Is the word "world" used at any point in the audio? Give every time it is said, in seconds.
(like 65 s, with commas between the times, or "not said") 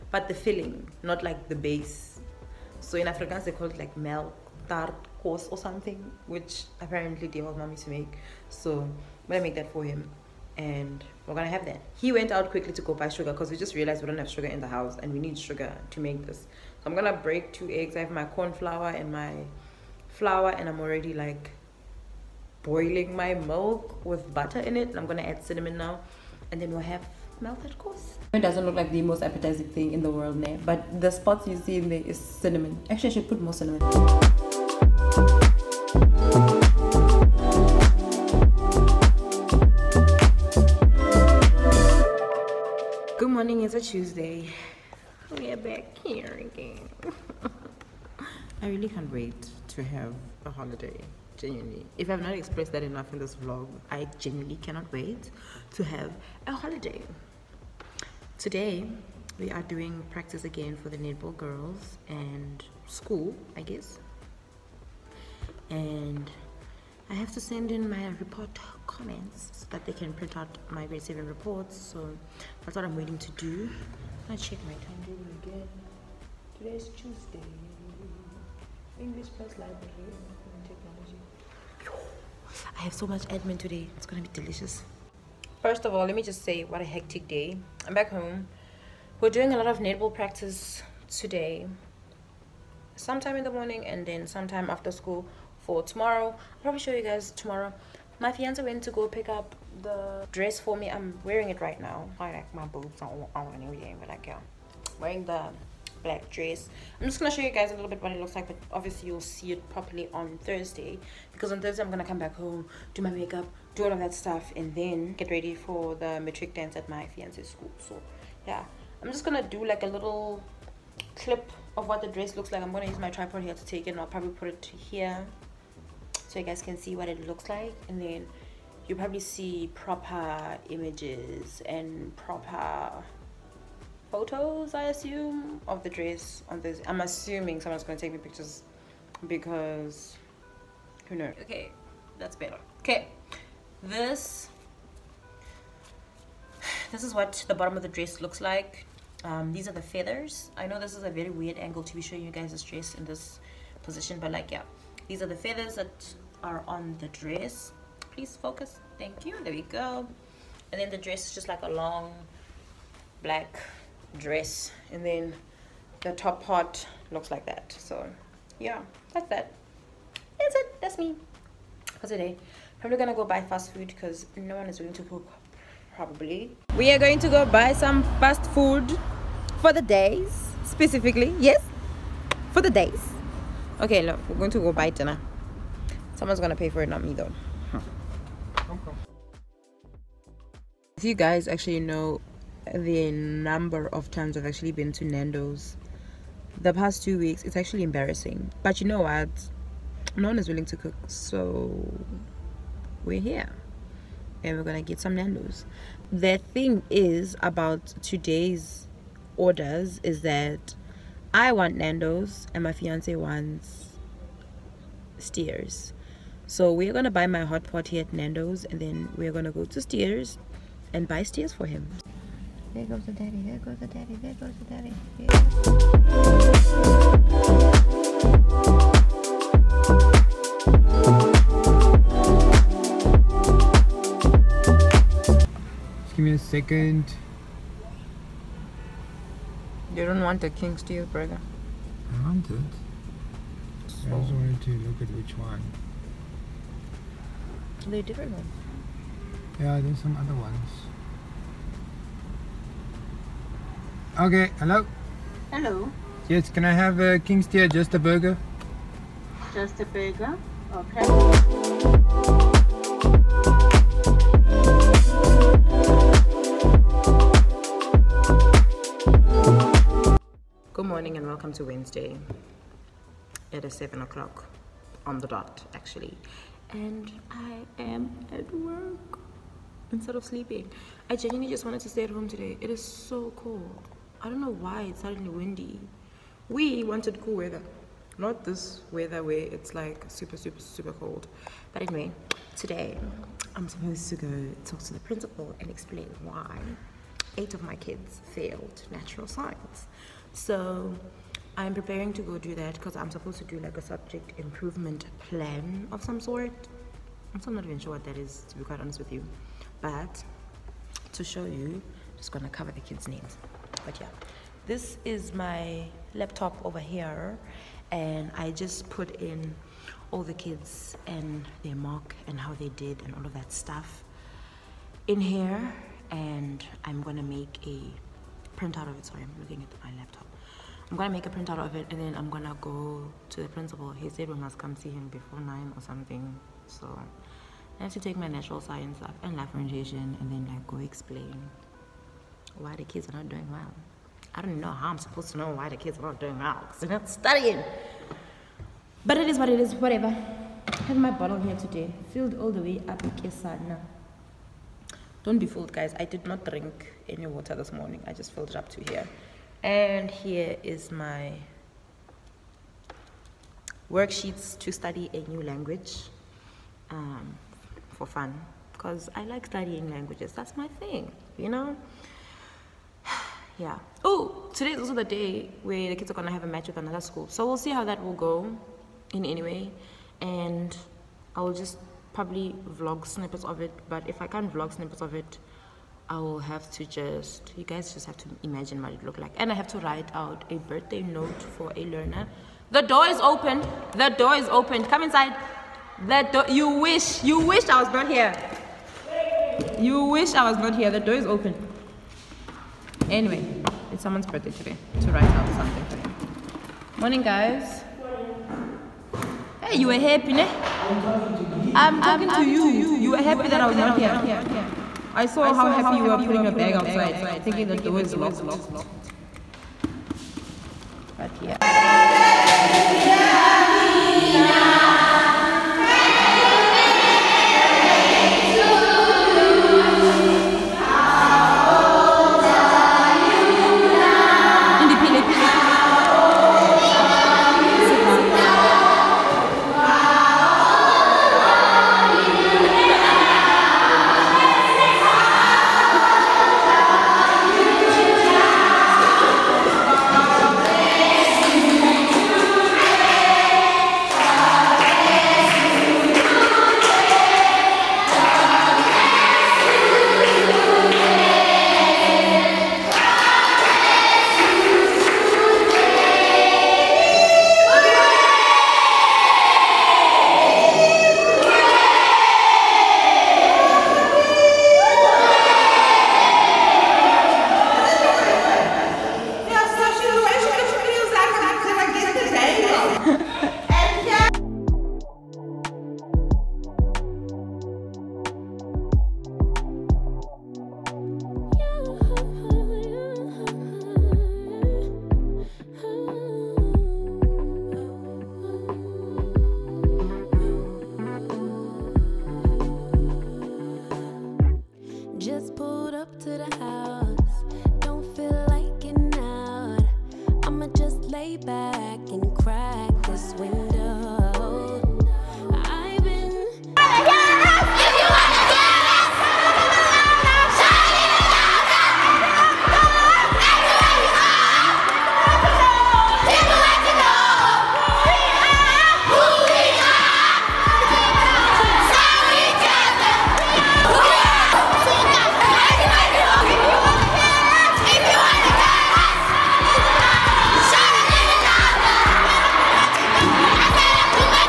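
30 s.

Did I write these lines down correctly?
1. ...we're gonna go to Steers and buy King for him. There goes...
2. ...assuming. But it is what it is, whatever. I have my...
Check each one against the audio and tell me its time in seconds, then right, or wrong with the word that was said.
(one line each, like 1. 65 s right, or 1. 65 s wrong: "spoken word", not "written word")
1. 219 s wrong: "Steers", not "King"
2. 347 s wrong: "studying", not "assuming".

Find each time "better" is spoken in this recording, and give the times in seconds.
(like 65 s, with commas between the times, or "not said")
142 s.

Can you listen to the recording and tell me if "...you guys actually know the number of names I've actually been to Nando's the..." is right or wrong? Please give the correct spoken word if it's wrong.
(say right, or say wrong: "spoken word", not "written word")
wrong: "times", not "names".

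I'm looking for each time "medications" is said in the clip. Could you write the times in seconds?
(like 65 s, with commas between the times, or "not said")
not said.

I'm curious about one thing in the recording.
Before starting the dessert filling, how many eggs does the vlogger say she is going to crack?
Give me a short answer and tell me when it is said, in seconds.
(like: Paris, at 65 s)
2, at 17 s.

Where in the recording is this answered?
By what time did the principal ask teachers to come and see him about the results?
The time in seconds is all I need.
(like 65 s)
335 s.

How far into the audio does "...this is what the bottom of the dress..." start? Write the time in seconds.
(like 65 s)
146 s.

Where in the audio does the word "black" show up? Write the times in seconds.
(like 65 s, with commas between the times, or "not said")
106 s, 163 s.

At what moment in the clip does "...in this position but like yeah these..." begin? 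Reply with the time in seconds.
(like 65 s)
152 s.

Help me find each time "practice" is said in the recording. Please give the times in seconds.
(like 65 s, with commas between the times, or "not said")
60 s, 90 s.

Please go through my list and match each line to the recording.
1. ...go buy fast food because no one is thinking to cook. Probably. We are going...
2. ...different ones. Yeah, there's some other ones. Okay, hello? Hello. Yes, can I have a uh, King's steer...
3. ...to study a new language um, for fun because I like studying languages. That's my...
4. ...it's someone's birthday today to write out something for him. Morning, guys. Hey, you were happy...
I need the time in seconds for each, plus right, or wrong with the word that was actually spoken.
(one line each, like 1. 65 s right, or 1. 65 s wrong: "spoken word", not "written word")
1. 173 s wrong: "willing", not "thinking"
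2. 248 s right
3. 364 s right
4. 403 s right.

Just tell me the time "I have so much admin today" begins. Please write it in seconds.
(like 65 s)
82 s.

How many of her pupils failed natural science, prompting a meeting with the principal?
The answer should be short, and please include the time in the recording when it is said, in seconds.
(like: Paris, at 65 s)
8, at 297 s.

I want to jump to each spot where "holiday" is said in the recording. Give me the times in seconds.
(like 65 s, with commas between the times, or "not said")
50 s, 56 s.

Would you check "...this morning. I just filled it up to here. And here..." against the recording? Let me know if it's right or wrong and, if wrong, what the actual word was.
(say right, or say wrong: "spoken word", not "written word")
right.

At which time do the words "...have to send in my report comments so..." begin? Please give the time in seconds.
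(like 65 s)
67 s.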